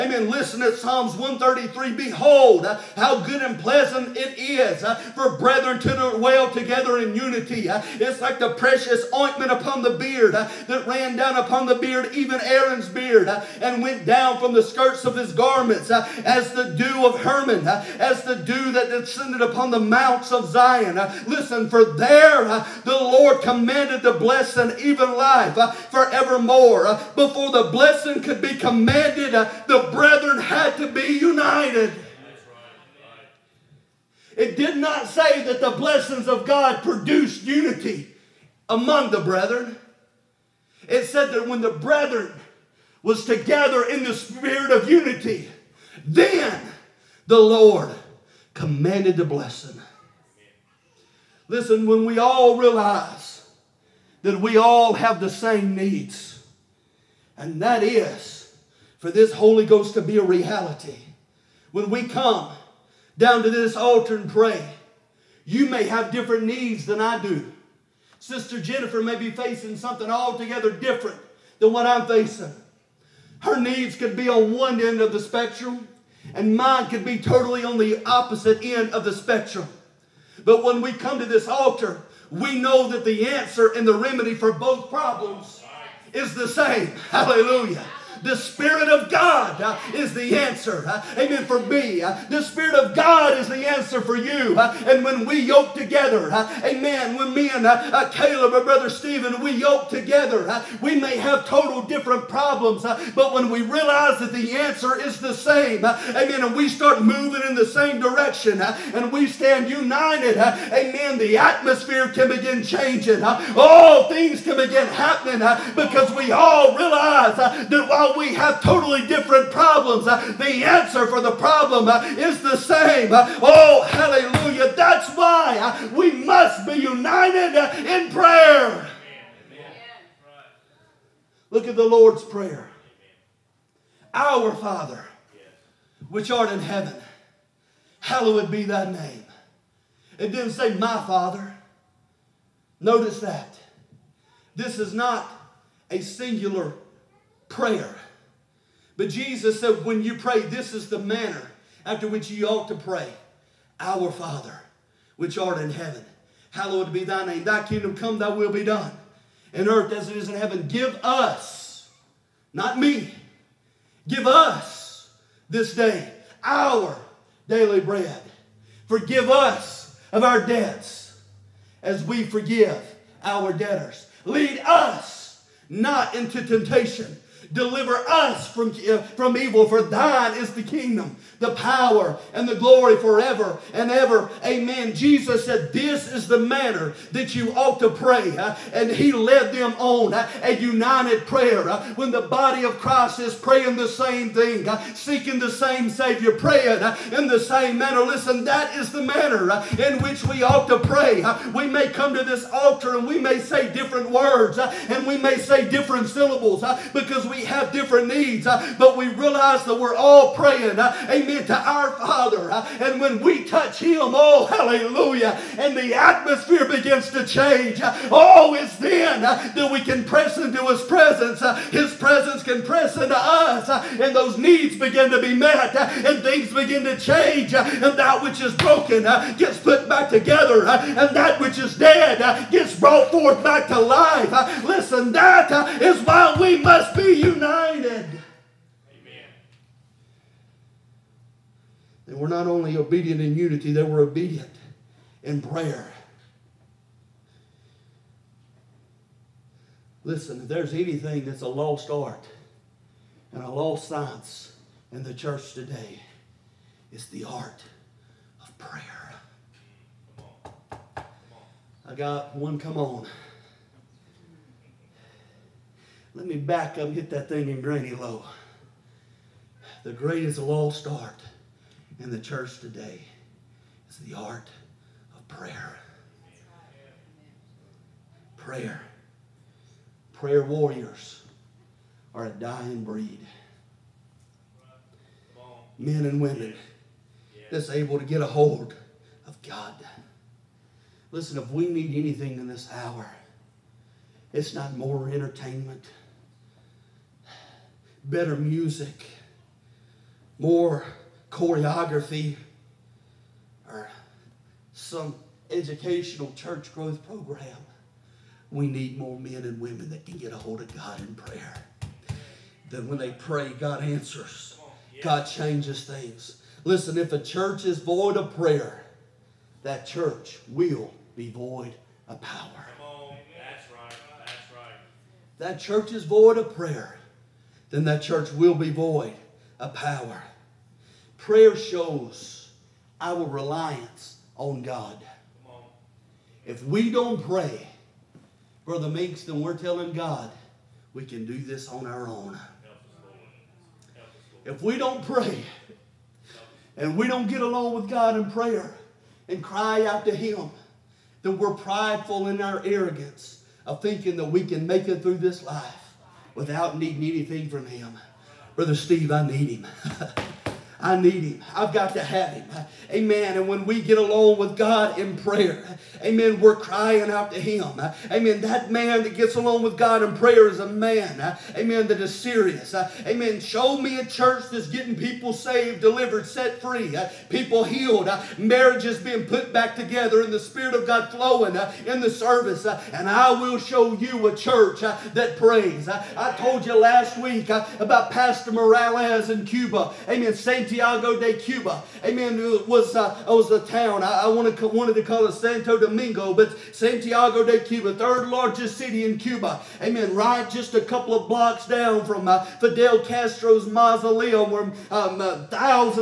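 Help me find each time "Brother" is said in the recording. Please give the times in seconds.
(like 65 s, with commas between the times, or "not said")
98 s, 338 s, 358 s.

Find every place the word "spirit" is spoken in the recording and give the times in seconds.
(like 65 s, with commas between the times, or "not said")
44 s, 88 s, 92 s, 380 s.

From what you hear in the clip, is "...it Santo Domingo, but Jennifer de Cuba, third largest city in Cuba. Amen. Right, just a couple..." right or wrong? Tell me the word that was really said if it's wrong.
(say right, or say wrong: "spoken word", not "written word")
wrong: "Santiago", not "Jennifer".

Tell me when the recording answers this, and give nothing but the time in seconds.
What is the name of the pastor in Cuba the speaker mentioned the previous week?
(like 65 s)
388 s.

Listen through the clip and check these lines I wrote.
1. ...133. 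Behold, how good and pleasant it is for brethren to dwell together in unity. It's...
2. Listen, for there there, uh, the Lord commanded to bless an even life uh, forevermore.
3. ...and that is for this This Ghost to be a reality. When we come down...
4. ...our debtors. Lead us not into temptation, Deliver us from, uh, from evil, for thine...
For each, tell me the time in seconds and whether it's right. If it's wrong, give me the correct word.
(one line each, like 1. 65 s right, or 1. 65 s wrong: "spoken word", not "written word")
1. 1 s right
2. 21 s right
3. 57 s wrong: "Holy", not "This"
4. 173 s right.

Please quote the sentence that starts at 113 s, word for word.
all things can begin happening because we all realize that while we have totally different problems.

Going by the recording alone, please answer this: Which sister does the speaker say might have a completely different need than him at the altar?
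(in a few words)
Sister Jennifer.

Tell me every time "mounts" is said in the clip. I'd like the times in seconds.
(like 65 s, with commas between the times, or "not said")
19 s.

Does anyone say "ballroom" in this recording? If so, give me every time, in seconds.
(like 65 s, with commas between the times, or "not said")
not said.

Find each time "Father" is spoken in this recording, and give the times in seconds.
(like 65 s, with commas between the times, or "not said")
134 s, 141 s, 154 s, 211 s.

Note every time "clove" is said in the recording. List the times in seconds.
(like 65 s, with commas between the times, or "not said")
not said.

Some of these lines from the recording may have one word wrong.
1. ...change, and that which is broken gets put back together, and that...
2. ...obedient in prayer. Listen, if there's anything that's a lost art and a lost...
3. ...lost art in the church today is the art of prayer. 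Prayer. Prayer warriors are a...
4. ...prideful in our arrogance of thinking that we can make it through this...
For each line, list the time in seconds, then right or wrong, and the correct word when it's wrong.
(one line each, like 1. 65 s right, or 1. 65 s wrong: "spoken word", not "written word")
1. 226 s right
2. 244 s right
3. 270 s right
4. 351 s right.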